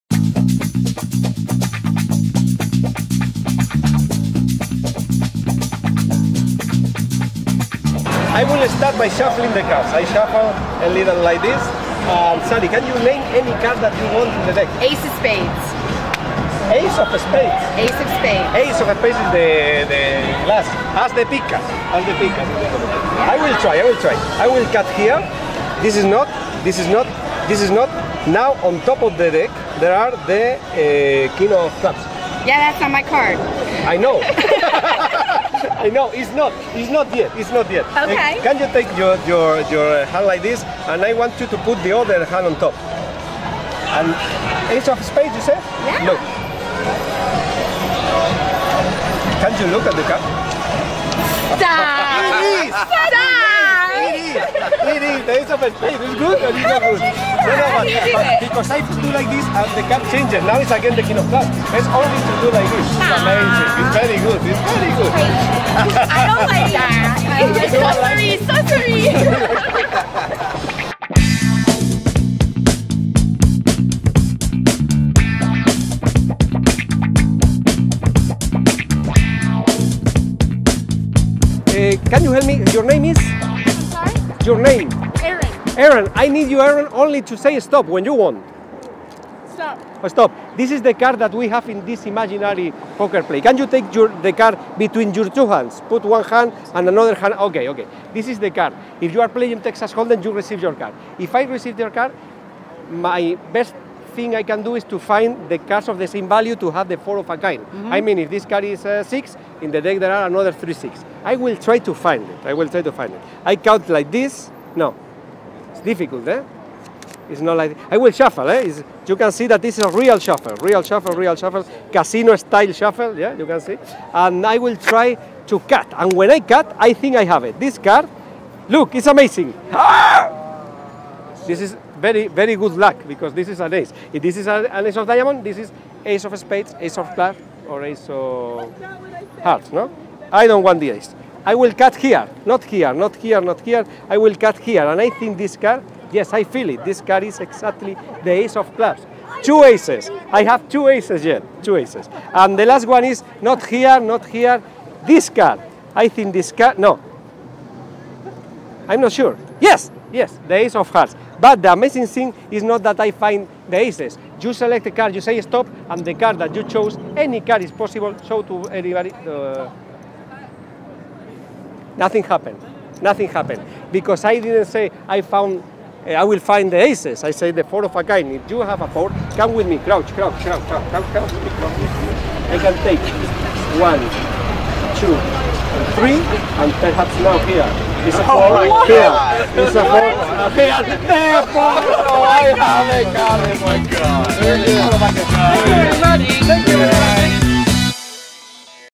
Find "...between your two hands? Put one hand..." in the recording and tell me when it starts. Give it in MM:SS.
01:34.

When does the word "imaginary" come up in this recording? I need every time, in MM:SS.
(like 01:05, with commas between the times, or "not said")
01:32.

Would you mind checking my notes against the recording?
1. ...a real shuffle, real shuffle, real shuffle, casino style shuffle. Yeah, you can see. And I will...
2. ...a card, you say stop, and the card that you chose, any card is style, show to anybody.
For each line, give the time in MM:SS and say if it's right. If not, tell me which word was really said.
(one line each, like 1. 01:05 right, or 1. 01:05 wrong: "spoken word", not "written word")
1. 01:59 right
2. 02:44 wrong: "possible", not "style".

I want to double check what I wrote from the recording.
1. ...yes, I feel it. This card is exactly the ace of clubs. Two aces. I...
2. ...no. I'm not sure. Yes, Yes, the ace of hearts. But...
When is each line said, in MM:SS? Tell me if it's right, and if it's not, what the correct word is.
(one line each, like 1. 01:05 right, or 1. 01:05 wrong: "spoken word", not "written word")
1. 02:26 right
2. 02:36 right.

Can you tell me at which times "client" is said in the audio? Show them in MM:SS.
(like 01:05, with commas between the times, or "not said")
not said.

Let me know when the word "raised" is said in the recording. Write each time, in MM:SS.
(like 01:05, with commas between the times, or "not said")
not said.